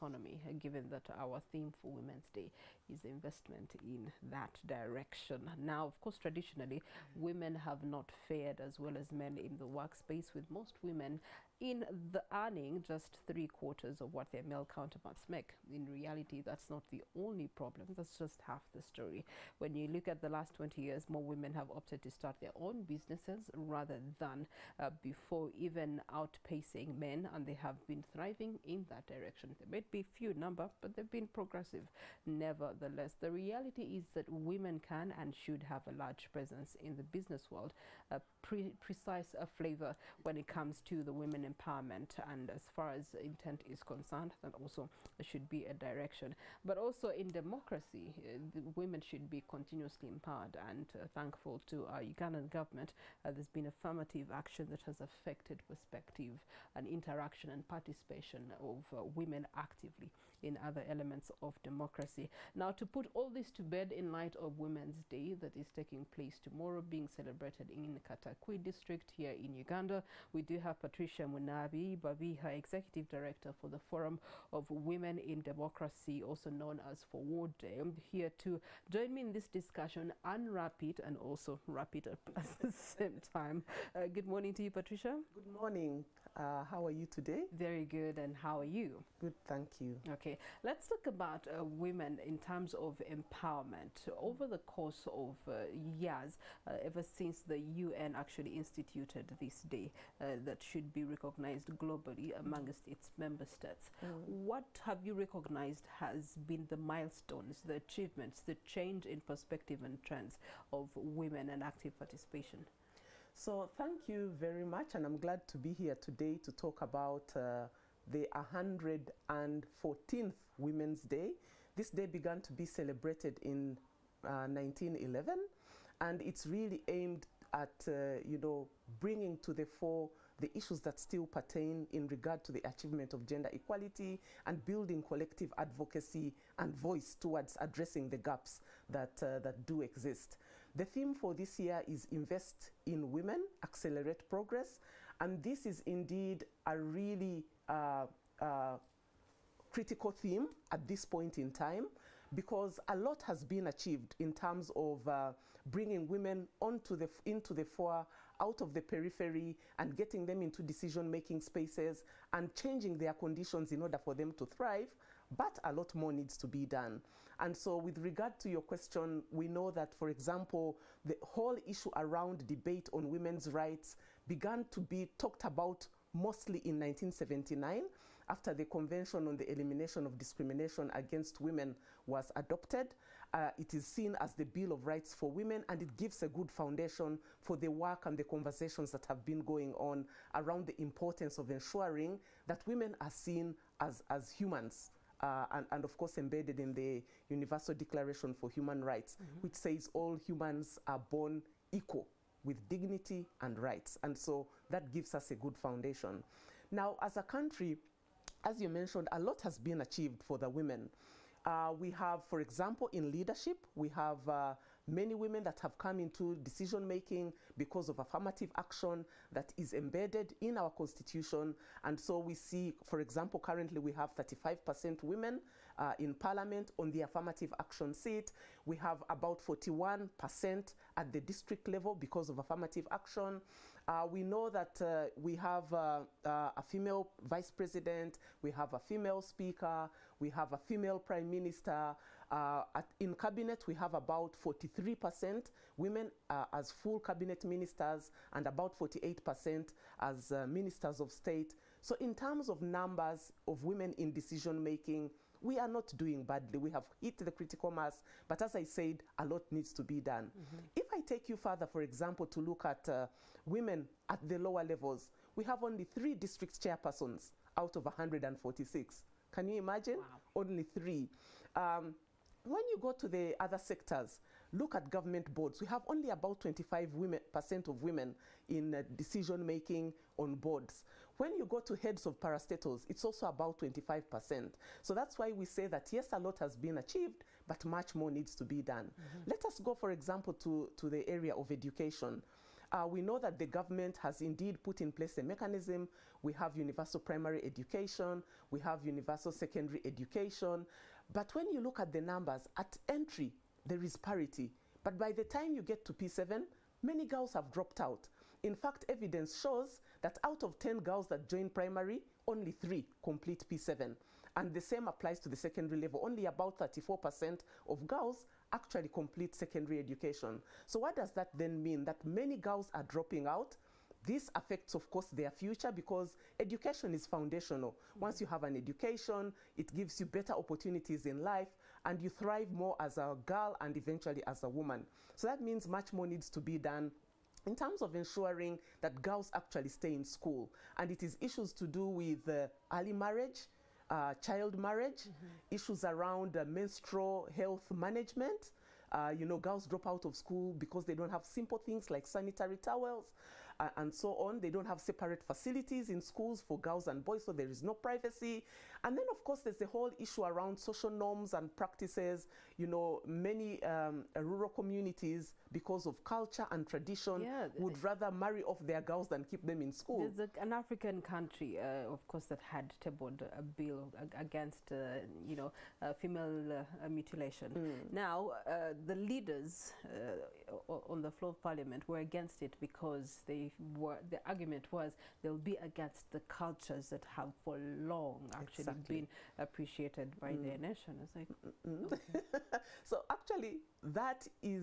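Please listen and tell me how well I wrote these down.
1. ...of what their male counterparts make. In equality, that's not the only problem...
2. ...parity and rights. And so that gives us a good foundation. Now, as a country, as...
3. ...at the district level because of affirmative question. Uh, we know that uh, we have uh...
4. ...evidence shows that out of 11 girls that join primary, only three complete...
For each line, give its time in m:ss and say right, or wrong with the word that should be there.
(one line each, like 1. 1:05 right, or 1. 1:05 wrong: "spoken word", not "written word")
1. 0:14 wrong: "reality", not "equality"
2. 3:22 wrong: "dignity", not "parity"
3. 3:50 wrong: "action", not "question"
4. 5:08 wrong: "10", not "11".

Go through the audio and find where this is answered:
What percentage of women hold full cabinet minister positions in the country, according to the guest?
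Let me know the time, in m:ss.
4:04.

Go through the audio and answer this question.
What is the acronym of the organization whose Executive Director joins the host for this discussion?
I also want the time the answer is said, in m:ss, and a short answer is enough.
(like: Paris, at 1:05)
FOWODE, at 1:17.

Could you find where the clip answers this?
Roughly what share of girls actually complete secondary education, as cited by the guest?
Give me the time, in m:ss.
5:16.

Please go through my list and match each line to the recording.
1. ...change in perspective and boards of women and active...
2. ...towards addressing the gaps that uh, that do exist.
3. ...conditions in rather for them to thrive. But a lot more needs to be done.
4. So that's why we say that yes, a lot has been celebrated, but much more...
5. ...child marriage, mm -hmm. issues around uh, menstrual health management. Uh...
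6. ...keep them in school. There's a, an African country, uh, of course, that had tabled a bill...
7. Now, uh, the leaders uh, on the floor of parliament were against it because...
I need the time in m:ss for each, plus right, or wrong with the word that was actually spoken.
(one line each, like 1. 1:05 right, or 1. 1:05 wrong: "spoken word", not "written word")
1. 1:48 wrong: "trends", not "boards"
2. 2:17 right
3. 2:43 wrong: "order", not "rather"
4. 4:44 wrong: "achieved", not "celebrated"
5. 5:44 right
6. 6:09 right
7. 6:17 right.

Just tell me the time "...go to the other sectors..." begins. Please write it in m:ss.
4:32.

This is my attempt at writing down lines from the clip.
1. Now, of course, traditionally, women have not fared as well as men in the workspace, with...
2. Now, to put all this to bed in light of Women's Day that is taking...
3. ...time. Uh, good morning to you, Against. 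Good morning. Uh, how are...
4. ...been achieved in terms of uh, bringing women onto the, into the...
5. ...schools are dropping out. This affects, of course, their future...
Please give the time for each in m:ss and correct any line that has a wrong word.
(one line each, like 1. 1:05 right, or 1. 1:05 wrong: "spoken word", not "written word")
1. 0:05 right
2. 1:02 right
3. 1:23 wrong: "Patricia", not "Against"
4. 2:33 right
5. 5:22 wrong: "girls", not "schools".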